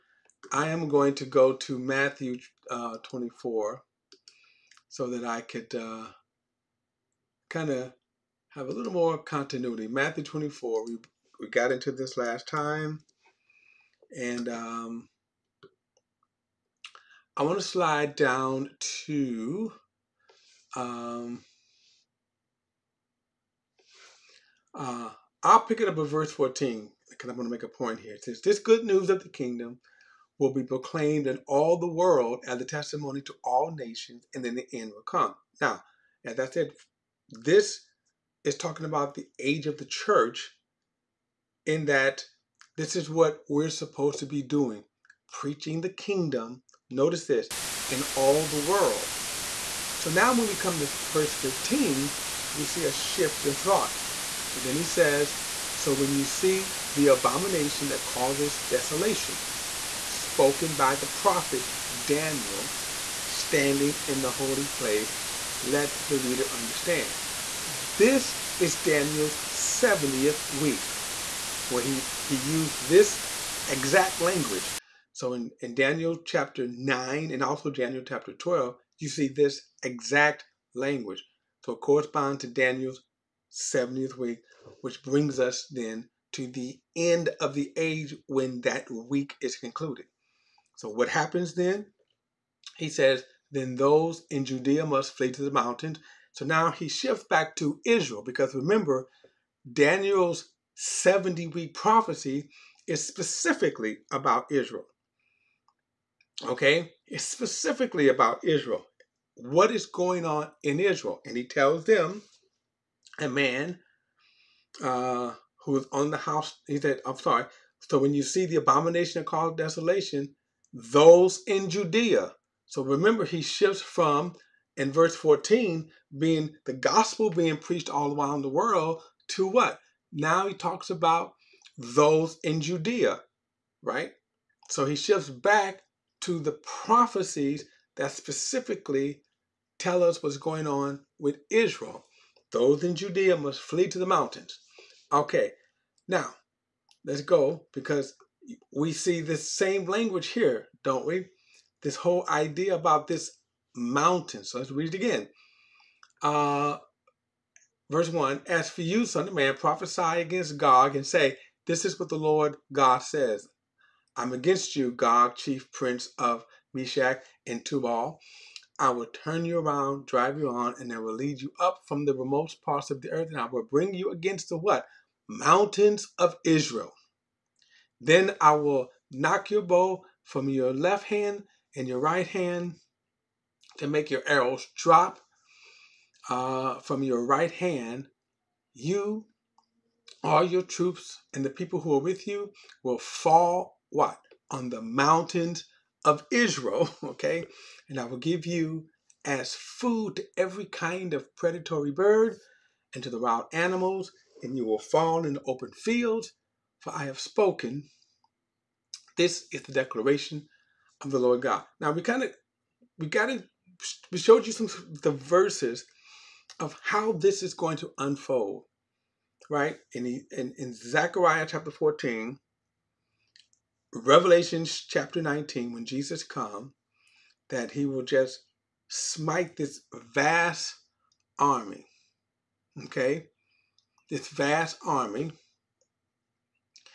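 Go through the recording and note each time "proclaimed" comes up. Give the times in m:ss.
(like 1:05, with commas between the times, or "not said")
0:30.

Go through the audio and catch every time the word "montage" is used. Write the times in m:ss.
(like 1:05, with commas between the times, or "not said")
not said.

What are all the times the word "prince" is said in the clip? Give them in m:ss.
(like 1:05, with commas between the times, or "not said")
2:45.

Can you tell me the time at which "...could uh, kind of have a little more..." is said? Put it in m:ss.
0:05.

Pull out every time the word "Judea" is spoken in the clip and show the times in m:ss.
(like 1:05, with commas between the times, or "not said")
1:34, 2:01, 2:12, 2:22.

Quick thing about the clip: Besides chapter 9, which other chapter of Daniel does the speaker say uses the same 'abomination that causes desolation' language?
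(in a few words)
Chapter 12.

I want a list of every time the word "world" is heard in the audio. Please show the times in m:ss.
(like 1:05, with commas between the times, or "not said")
0:31, 0:48, 2:08.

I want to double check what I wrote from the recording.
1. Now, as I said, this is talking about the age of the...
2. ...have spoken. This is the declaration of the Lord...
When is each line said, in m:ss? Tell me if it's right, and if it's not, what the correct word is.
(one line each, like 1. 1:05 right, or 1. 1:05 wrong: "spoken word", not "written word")
1. 0:35 right
2. 3:27 right.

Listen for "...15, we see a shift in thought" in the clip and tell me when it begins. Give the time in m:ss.
0:51.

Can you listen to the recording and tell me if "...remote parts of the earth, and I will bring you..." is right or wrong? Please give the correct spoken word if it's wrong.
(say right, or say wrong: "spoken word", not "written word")
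right.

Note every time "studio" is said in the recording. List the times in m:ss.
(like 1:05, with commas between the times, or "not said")
not said.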